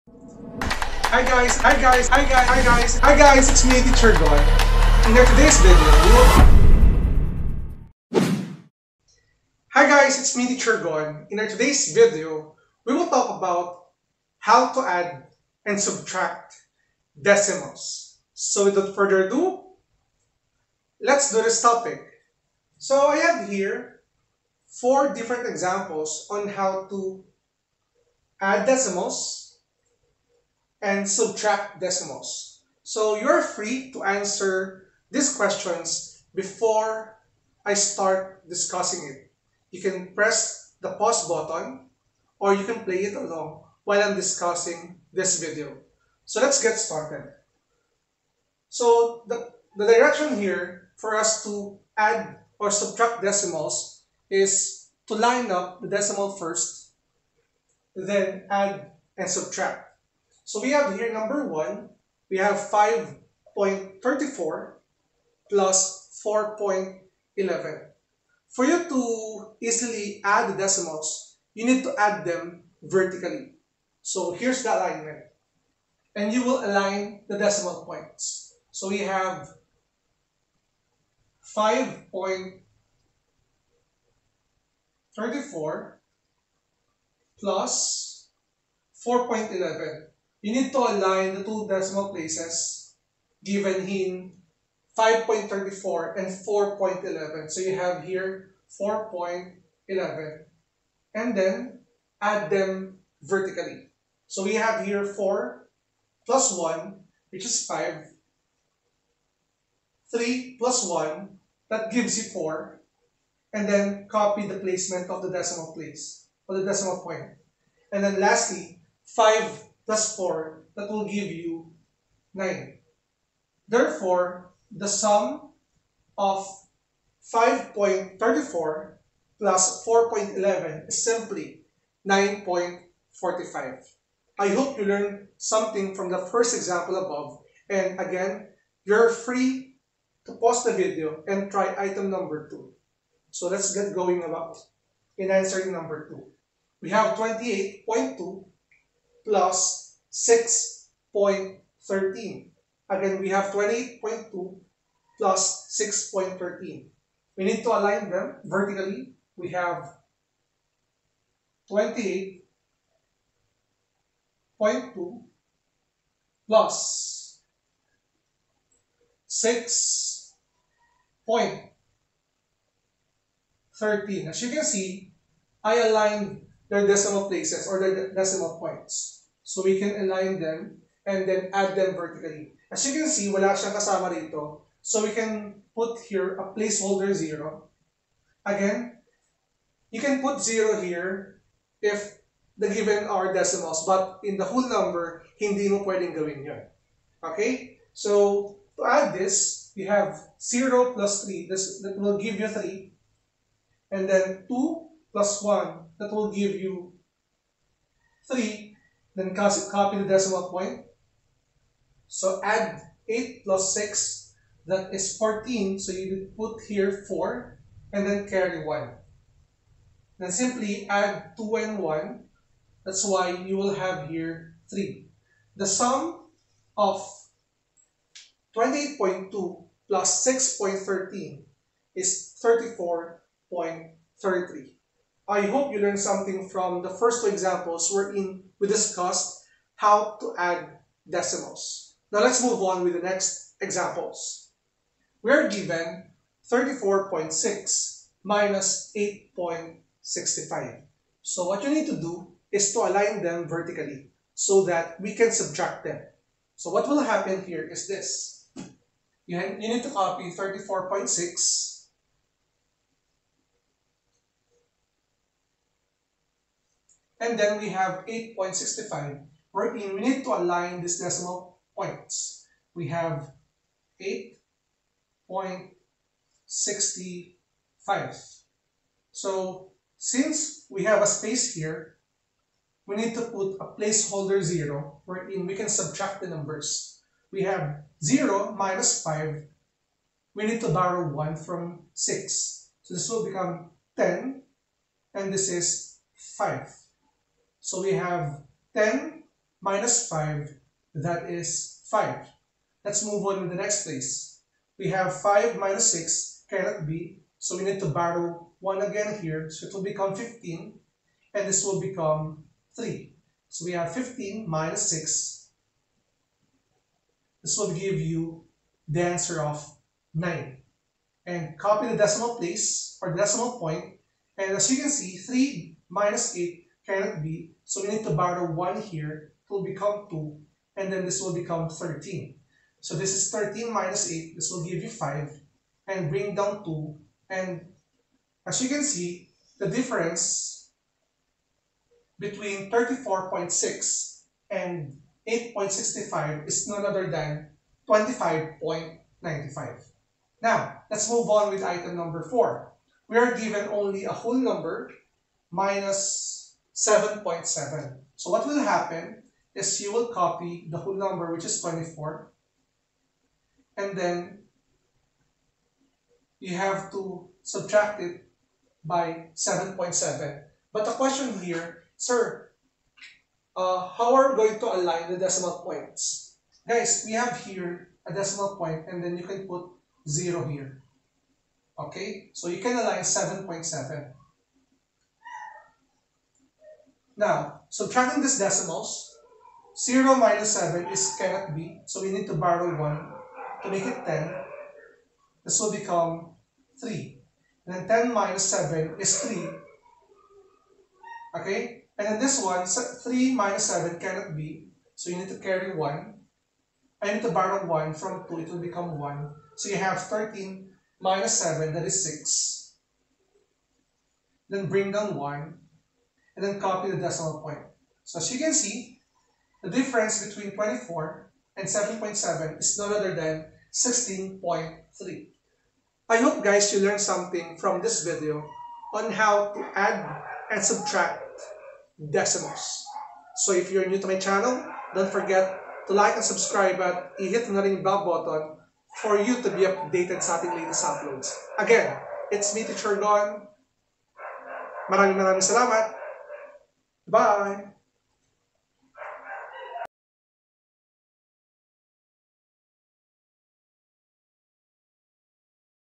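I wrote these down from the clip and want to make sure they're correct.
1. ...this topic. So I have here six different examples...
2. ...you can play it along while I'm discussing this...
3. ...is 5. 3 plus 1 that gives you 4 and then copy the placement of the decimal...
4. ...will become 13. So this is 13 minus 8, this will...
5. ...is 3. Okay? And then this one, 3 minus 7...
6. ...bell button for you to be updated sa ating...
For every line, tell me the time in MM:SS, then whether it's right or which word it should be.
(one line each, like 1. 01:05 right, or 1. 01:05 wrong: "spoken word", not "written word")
1. 00:21 wrong: "four", not "six"
2. 00:42 right
3. 01:47 right
4. 05:31 right
5. 06:38 right
6. 07:17 right.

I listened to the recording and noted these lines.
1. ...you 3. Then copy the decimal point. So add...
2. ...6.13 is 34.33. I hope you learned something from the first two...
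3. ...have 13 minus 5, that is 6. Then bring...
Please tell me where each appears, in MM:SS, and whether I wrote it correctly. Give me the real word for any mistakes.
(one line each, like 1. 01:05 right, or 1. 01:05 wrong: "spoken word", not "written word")
1. 03:26 right
2. 03:50 right
3. 06:49 wrong: "7", not "5".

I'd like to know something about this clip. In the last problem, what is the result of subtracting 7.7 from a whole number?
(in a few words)
16.3.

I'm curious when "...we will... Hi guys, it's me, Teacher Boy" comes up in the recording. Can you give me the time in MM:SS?
00:08.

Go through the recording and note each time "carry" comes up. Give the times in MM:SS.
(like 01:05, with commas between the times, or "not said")
03:38, 06:45.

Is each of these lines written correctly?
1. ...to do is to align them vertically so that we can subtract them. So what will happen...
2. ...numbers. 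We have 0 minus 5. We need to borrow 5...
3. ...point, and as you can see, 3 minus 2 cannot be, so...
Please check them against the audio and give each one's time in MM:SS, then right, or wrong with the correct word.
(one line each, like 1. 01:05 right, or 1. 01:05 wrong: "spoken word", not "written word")
1. 04:11 right
2. 04:46 wrong: "1", not "5"
3. 05:23 wrong: "8", not "2".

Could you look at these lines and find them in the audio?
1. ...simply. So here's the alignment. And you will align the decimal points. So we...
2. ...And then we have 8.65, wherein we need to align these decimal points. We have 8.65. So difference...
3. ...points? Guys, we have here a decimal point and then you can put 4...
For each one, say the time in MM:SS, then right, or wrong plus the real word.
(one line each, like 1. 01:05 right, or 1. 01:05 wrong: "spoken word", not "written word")
1. 01:12 wrong: "vertically", not "simply"
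2. 04:27 wrong: "since", not "difference"
3. 06:15 wrong: "0", not "4".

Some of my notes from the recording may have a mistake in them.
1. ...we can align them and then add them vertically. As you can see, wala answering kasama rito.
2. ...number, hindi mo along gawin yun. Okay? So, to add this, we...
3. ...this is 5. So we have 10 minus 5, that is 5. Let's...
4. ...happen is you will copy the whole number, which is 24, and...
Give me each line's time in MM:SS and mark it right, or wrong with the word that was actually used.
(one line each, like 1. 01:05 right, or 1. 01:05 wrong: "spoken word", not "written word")
1. 02:59 wrong: "siyang", not "answering"
2. 03:14 wrong: "pwedeng", not "along"
3. 04:55 right
4. 05:58 right.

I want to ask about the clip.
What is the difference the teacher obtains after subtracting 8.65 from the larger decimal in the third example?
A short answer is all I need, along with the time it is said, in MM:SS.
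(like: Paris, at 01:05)
25.95, at 05:47.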